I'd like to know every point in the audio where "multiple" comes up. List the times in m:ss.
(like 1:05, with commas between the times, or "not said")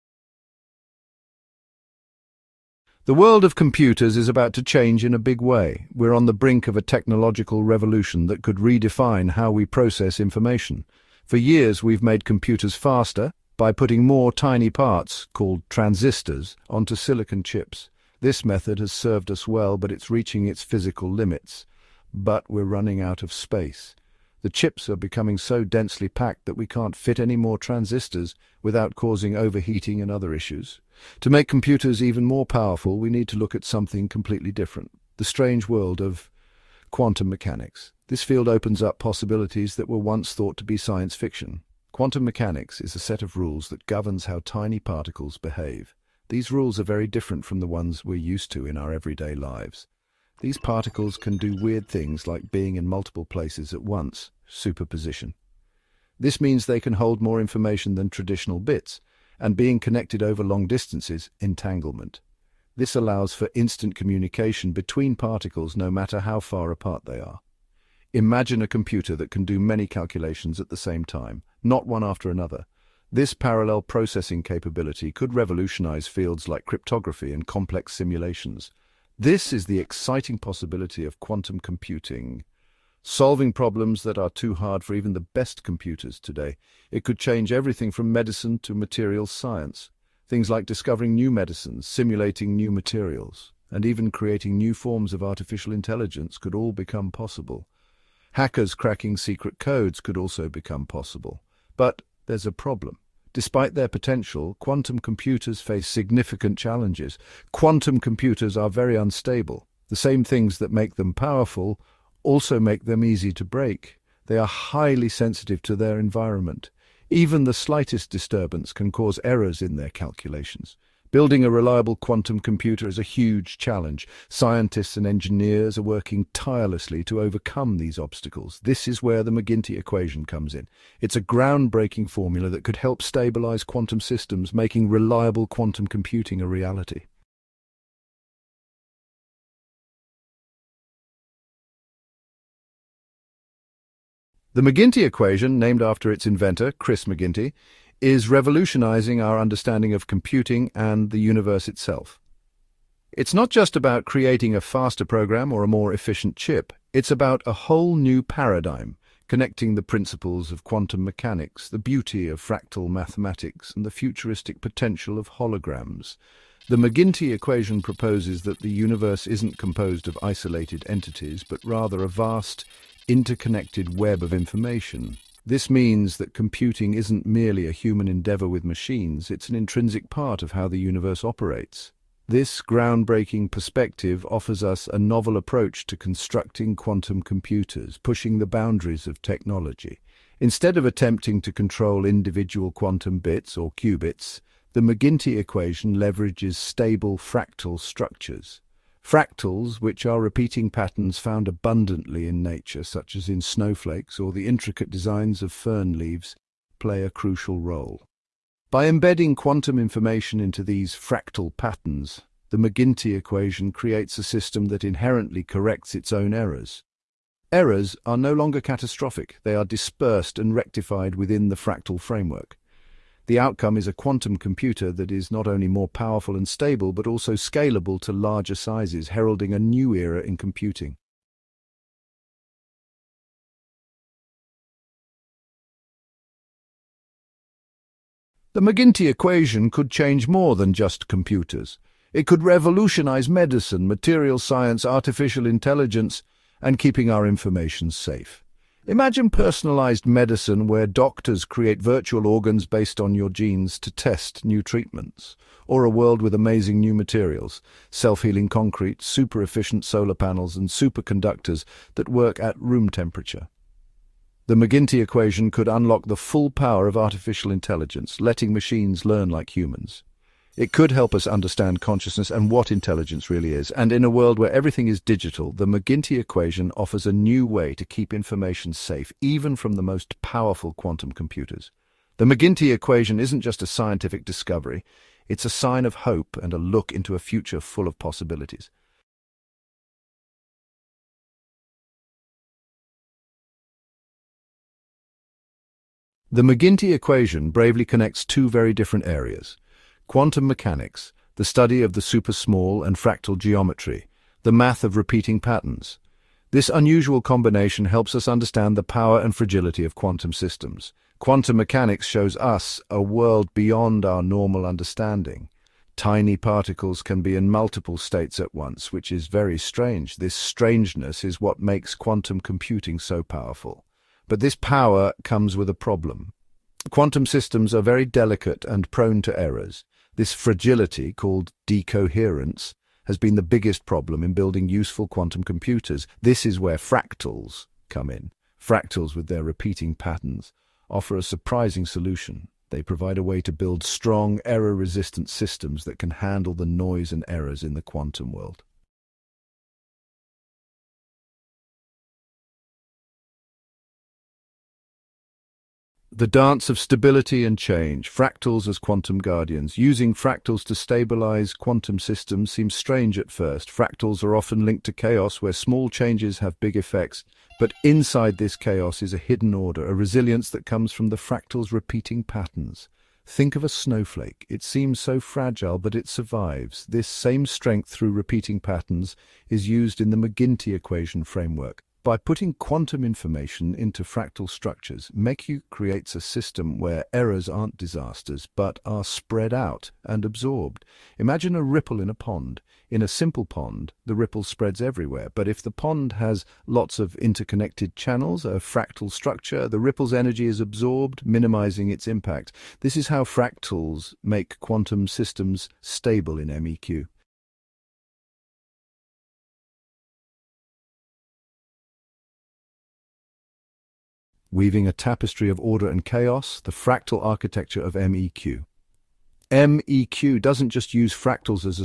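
0:52, 5:17.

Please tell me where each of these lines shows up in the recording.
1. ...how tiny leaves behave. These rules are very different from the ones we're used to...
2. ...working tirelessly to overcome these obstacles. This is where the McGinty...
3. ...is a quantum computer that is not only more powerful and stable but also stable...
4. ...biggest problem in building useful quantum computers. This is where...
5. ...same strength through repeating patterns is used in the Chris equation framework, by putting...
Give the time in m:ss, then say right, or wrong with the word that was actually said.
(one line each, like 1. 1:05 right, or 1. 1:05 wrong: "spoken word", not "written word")
1. 0:44 wrong: "particles", not "leaves"
2. 2:05 right
3. 3:43 wrong: "scalable", not "stable"
4. 5:33 right
5. 6:17 wrong: "McGinty", not "Chris".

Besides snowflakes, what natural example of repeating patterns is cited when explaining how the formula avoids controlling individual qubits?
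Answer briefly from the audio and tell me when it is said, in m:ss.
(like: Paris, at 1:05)
fern leaves, at 3:25.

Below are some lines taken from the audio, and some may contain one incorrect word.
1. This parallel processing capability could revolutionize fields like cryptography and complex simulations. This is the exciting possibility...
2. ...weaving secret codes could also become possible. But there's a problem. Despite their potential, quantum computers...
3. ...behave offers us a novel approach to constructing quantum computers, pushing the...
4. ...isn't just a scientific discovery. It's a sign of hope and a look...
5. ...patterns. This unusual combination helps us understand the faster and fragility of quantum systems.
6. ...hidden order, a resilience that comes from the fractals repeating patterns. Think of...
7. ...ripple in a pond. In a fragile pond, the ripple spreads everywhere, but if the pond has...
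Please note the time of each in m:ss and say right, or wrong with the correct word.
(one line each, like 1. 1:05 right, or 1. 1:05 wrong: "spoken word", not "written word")
1. 1:13 right
2. 1:38 wrong: "cracking", not "weaving"
3. 3:03 wrong: "perspective", not "behave"
4. 4:43 right
5. 5:05 wrong: "power", not "faster"
6. 6:09 right
7. 6:31 wrong: "simple", not "fragile".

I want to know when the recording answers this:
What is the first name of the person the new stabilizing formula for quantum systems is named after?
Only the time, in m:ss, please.
2:26.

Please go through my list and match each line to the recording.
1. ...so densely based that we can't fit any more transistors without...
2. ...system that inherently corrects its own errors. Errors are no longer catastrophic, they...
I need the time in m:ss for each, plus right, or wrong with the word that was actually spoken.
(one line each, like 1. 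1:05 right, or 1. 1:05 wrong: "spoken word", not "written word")
1. 0:25 wrong: "packed", not "based"
2. 3:34 right.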